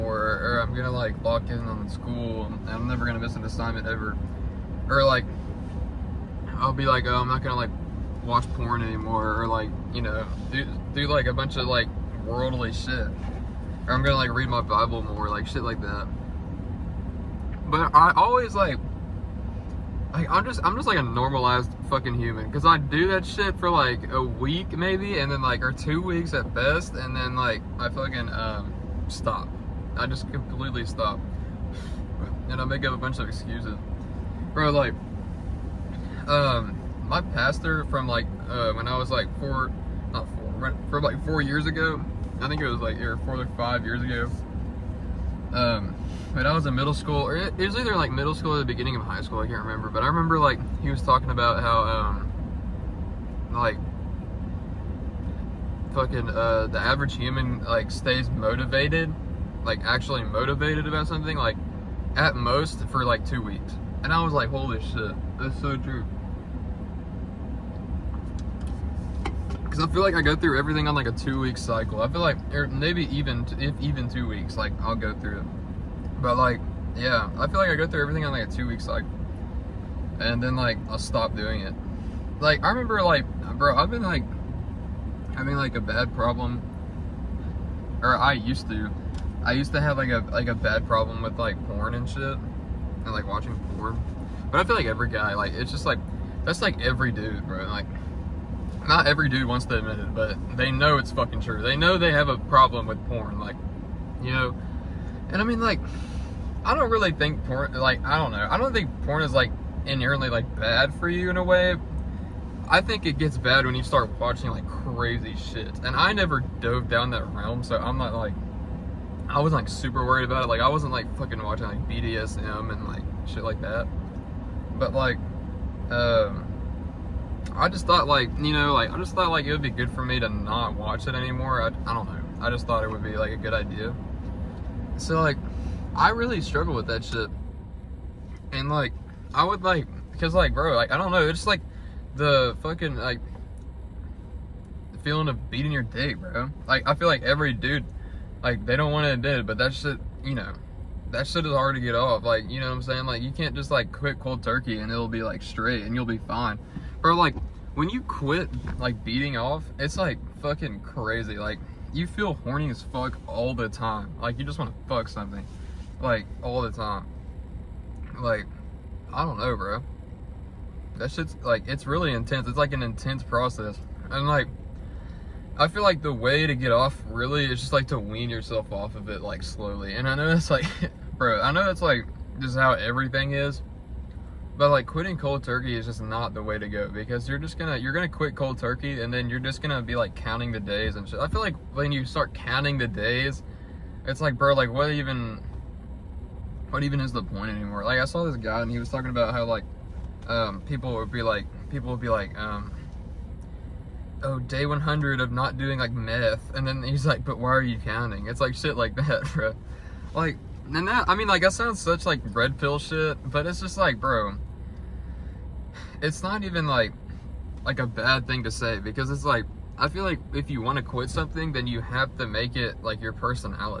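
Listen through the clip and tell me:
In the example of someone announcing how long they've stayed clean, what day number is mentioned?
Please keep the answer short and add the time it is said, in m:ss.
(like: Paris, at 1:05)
100, at 3:24.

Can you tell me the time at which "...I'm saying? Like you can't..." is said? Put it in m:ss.
2:32.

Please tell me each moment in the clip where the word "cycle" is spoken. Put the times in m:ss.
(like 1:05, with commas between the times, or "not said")
1:11, 1:18.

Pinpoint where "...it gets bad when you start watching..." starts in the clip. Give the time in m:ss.
1:53.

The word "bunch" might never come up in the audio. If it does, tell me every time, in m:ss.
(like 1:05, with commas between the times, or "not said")
0:11, 0:32.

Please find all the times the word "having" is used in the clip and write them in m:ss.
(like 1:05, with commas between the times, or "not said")
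1:25.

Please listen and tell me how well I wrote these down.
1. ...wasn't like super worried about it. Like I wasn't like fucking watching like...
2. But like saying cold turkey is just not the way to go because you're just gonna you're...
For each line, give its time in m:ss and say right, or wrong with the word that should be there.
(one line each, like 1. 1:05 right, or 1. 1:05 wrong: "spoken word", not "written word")
1. 1:59 right
2. 3:04 wrong: "quitting", not "saying".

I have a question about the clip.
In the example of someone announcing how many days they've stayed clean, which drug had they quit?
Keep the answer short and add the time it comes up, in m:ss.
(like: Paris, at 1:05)
meth, at 3:25.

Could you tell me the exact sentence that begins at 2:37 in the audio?
Or like when you quit like beating off, it's like fucking crazy.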